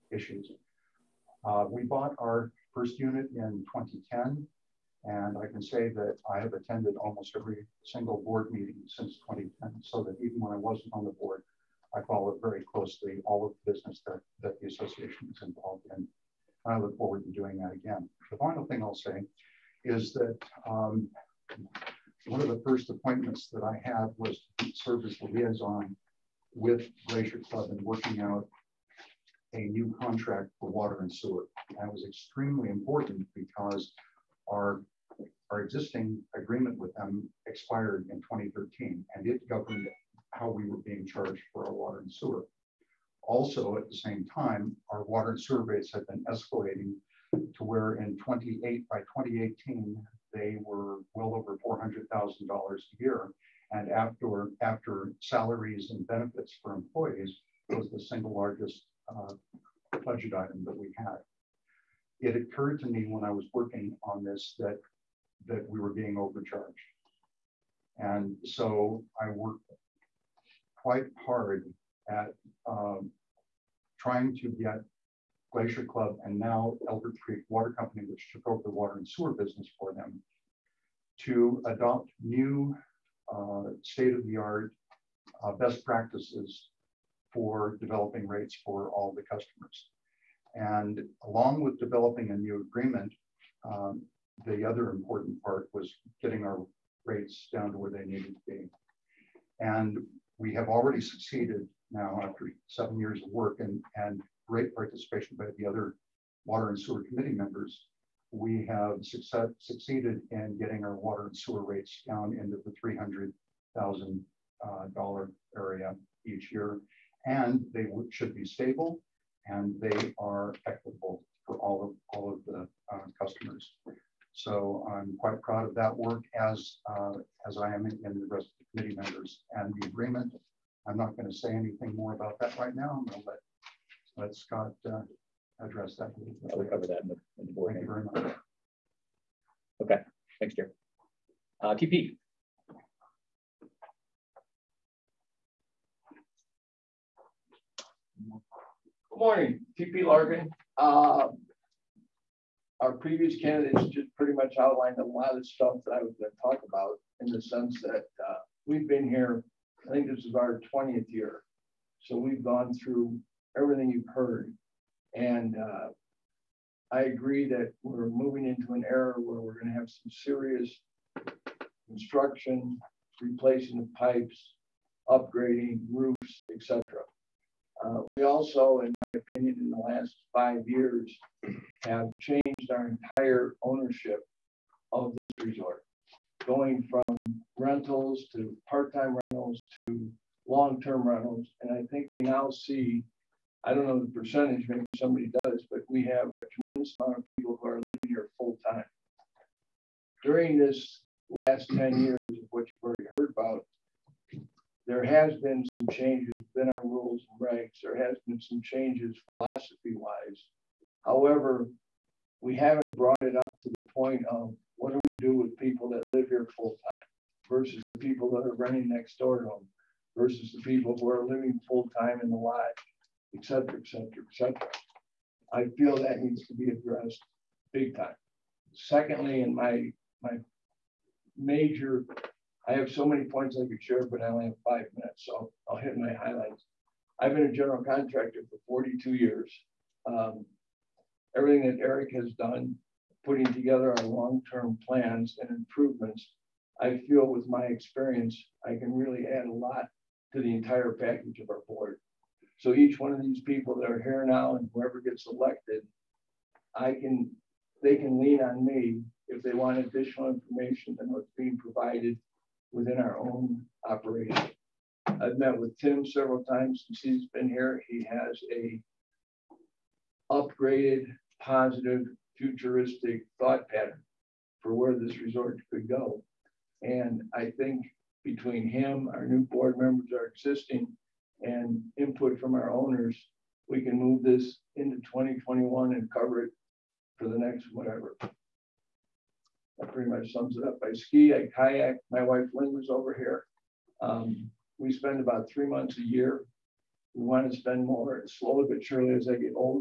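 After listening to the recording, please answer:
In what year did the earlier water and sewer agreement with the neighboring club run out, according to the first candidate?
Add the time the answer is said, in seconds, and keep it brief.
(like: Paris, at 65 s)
2013, at 38 s.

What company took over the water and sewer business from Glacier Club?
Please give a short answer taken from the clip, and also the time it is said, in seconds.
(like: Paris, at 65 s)
Elder Creek Water Company, at 76 s.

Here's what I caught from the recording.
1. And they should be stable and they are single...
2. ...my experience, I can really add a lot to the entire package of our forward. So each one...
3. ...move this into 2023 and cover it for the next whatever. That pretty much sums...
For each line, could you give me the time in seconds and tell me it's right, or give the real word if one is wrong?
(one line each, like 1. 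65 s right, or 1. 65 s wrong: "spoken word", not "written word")
1. 117 s wrong: "equitable", not "single"
2. 247 s wrong: "board", not "forward"
3. 283 s wrong: "2021", not "2023".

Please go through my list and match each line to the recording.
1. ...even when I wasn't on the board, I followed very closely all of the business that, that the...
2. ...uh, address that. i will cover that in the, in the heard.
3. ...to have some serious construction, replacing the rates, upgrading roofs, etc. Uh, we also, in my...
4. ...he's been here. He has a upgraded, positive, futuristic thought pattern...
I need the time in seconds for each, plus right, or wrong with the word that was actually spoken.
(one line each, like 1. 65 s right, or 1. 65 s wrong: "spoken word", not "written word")
1. 10 s right
2. 134 s wrong: "board", not "heard"
3. 169 s wrong: "pipes", not "rates"
4. 266 s right.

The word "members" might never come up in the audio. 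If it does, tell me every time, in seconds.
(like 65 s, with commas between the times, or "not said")
107 s, 128 s, 279 s.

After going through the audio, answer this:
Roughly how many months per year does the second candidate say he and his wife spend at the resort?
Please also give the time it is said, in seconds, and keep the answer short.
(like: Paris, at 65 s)
3 months, at 295 s.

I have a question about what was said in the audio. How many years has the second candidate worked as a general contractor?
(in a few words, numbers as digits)
42.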